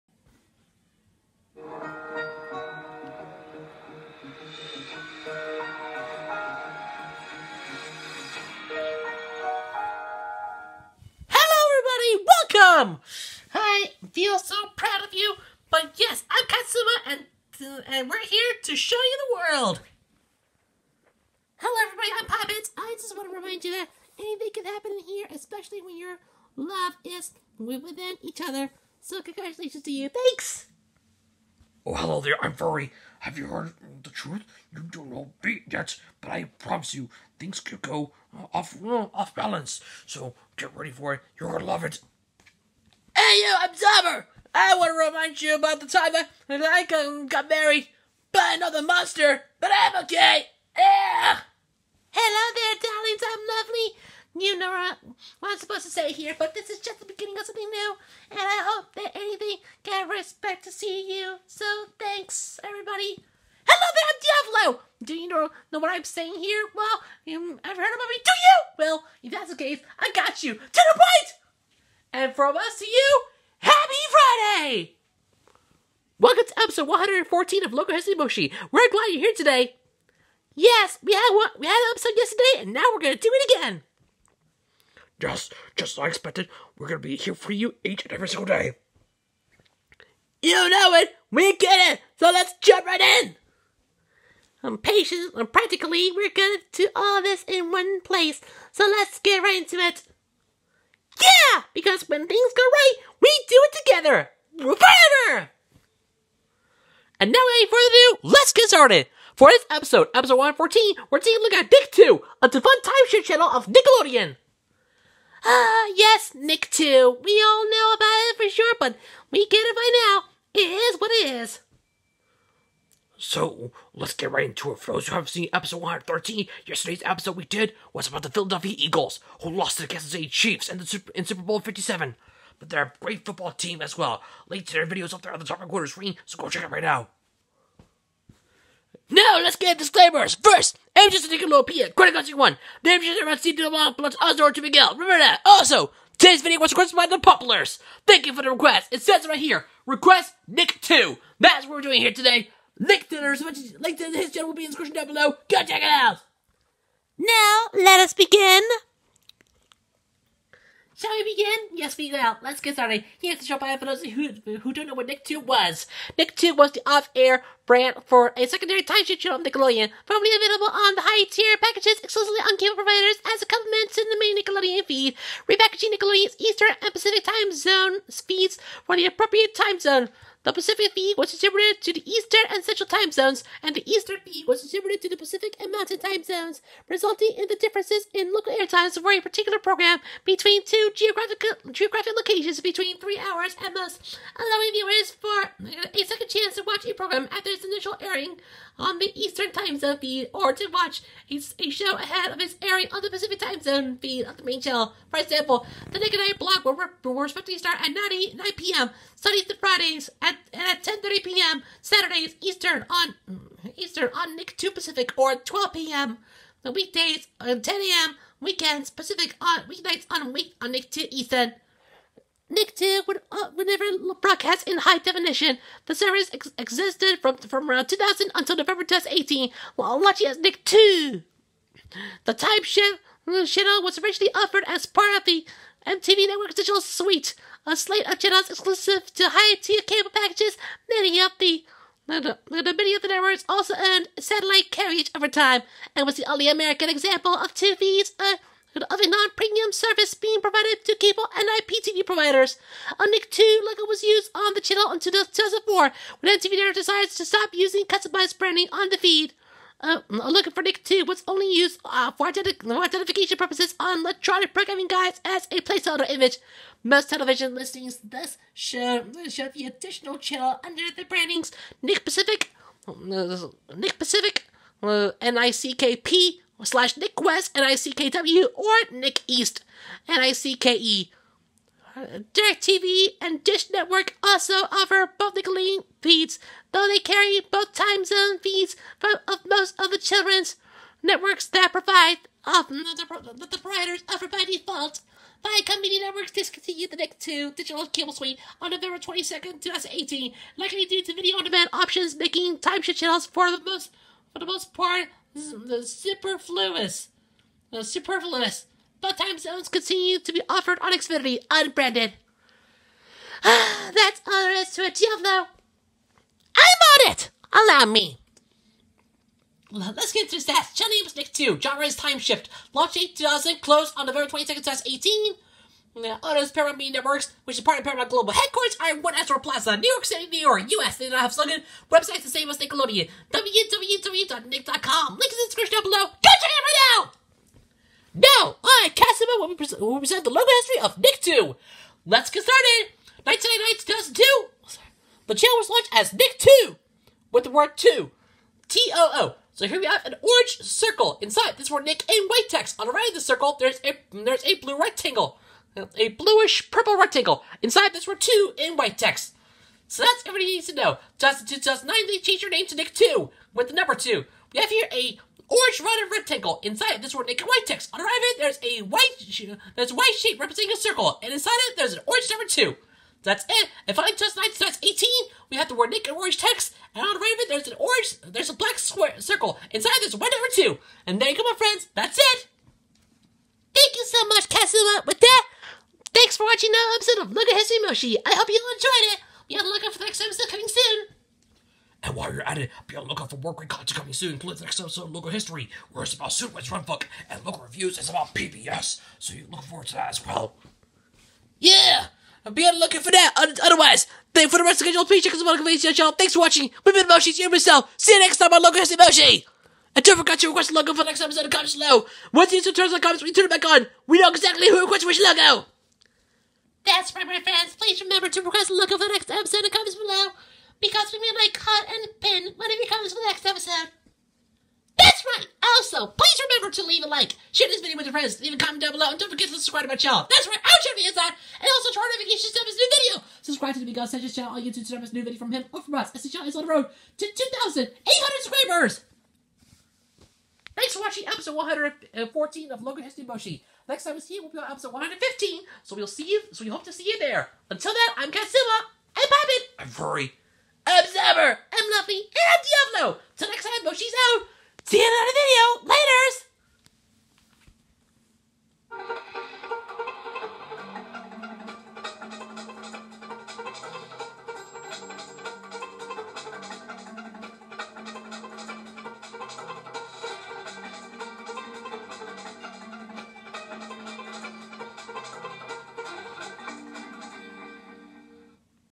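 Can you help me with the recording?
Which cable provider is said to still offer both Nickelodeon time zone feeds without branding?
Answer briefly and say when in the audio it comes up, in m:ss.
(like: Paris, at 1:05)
Xfinity, at 5:10.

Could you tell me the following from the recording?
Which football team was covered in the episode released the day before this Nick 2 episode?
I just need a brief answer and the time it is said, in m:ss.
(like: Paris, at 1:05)
Philadelphia Eagles, at 2:08.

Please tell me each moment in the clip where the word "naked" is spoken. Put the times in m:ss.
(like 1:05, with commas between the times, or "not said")
6:07, 6:15.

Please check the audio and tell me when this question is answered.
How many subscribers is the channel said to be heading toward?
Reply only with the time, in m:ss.
7:17.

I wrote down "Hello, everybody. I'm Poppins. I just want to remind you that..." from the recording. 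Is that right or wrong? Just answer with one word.
right.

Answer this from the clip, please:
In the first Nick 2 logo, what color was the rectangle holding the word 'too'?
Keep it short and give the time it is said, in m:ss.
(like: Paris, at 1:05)
Bluish purple, at 5:56.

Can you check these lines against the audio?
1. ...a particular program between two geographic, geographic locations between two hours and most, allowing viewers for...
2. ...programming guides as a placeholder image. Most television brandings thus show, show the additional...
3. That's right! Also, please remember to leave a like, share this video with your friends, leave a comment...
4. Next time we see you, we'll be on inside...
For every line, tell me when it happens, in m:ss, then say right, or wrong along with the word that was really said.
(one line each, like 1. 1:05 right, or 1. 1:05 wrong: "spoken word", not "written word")
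1. 3:09 wrong: "three", not "two"
2. 4:24 wrong: "listings", not "brandings"
3. 7:04 right
4. 7:23 wrong: "episode", not "inside".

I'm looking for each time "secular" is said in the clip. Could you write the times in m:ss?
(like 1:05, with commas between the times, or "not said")
not said.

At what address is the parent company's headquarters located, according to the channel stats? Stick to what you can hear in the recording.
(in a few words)
One Astor Plaza.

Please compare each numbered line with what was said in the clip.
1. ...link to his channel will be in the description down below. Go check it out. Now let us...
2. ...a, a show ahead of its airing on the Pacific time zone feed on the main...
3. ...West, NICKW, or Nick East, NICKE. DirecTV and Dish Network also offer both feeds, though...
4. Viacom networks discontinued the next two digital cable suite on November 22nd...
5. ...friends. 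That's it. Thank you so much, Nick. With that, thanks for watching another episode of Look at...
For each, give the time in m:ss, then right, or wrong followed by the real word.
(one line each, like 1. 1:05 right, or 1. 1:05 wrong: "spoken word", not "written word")
1. 2:33 right
2. 3:21 right
3. 4:37 right
4. 4:55 right
5. 6:21 wrong: "Katsuma", not "Nick".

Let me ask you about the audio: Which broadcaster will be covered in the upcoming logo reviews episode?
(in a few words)
PBS.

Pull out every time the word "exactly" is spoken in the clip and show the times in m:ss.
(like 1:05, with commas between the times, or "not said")
6:54.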